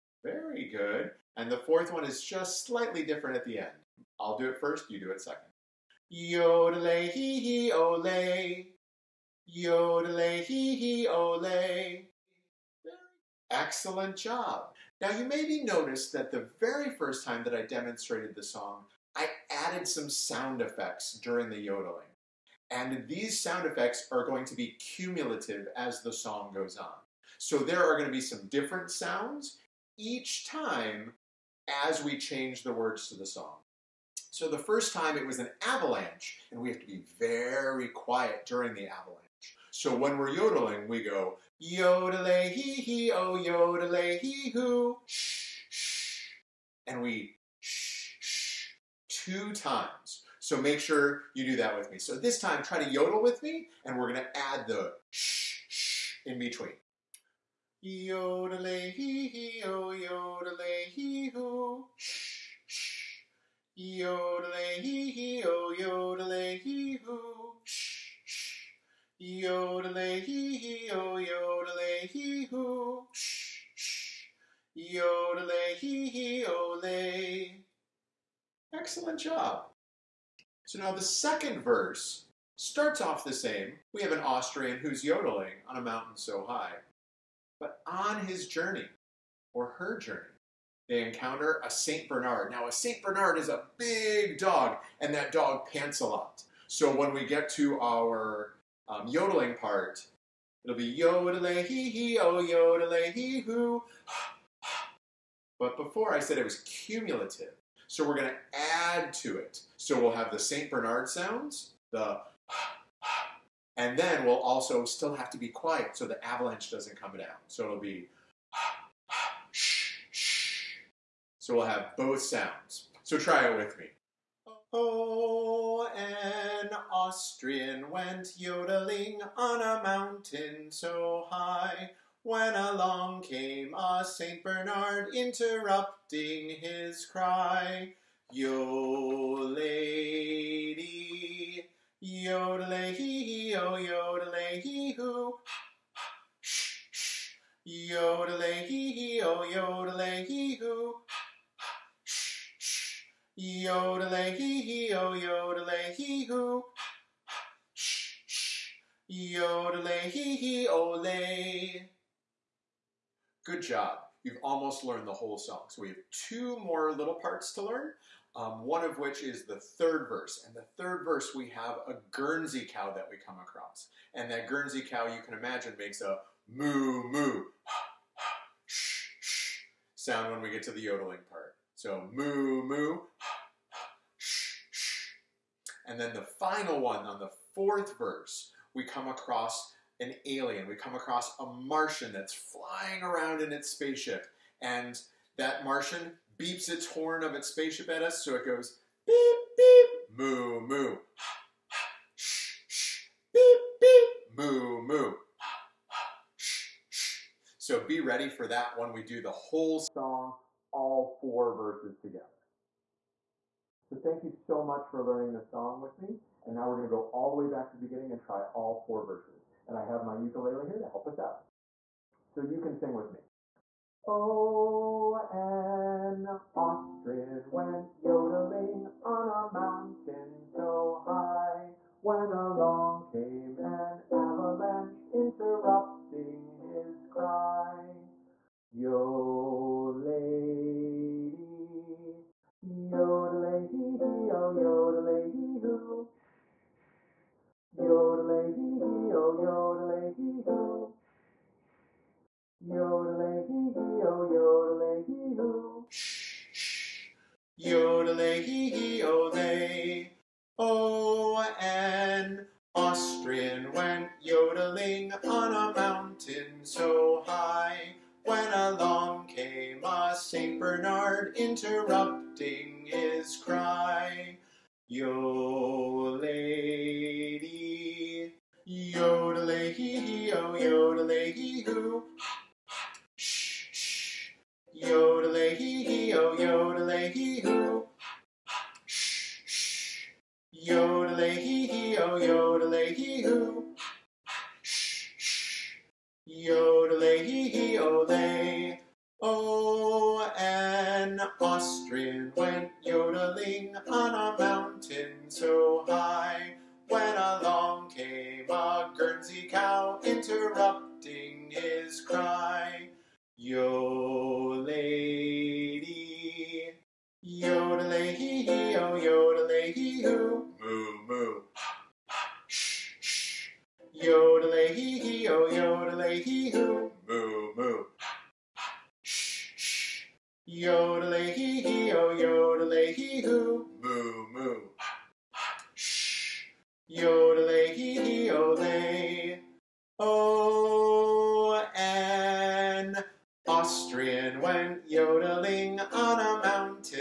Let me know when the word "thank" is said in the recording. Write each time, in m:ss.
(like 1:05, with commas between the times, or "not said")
3:34.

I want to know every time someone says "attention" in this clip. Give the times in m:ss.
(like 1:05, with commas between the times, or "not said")
not said.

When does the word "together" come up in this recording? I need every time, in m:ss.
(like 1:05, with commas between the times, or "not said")
3:31.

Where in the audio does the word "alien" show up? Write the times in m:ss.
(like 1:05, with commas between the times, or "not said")
3:10.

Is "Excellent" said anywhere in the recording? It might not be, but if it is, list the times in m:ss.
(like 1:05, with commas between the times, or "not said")
0:13, 1:18.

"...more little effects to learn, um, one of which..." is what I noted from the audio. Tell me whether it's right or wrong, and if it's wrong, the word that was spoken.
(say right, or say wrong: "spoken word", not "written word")
wrong: "parts", not "effects".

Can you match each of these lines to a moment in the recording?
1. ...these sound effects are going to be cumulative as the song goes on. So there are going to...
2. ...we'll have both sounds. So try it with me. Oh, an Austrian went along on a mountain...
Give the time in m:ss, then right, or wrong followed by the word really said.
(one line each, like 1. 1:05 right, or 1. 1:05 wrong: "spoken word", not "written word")
1. 0:23 right
2. 2:01 wrong: "yodeling", not "along".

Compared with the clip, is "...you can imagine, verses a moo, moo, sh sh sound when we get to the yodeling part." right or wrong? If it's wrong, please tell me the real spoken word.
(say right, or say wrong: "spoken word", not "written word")
wrong: "makes", not "verses".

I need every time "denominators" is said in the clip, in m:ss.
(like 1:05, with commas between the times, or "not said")
not said.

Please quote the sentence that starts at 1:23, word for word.
We have an Austrian who's yodeling on a mountain so high.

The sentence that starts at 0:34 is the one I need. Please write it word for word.
So the first time it was an avalanche, and we have to be very quiet during the avalanche.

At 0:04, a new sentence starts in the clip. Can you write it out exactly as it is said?
I'll do it first, you do it second.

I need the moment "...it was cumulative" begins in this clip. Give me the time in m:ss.
1:46.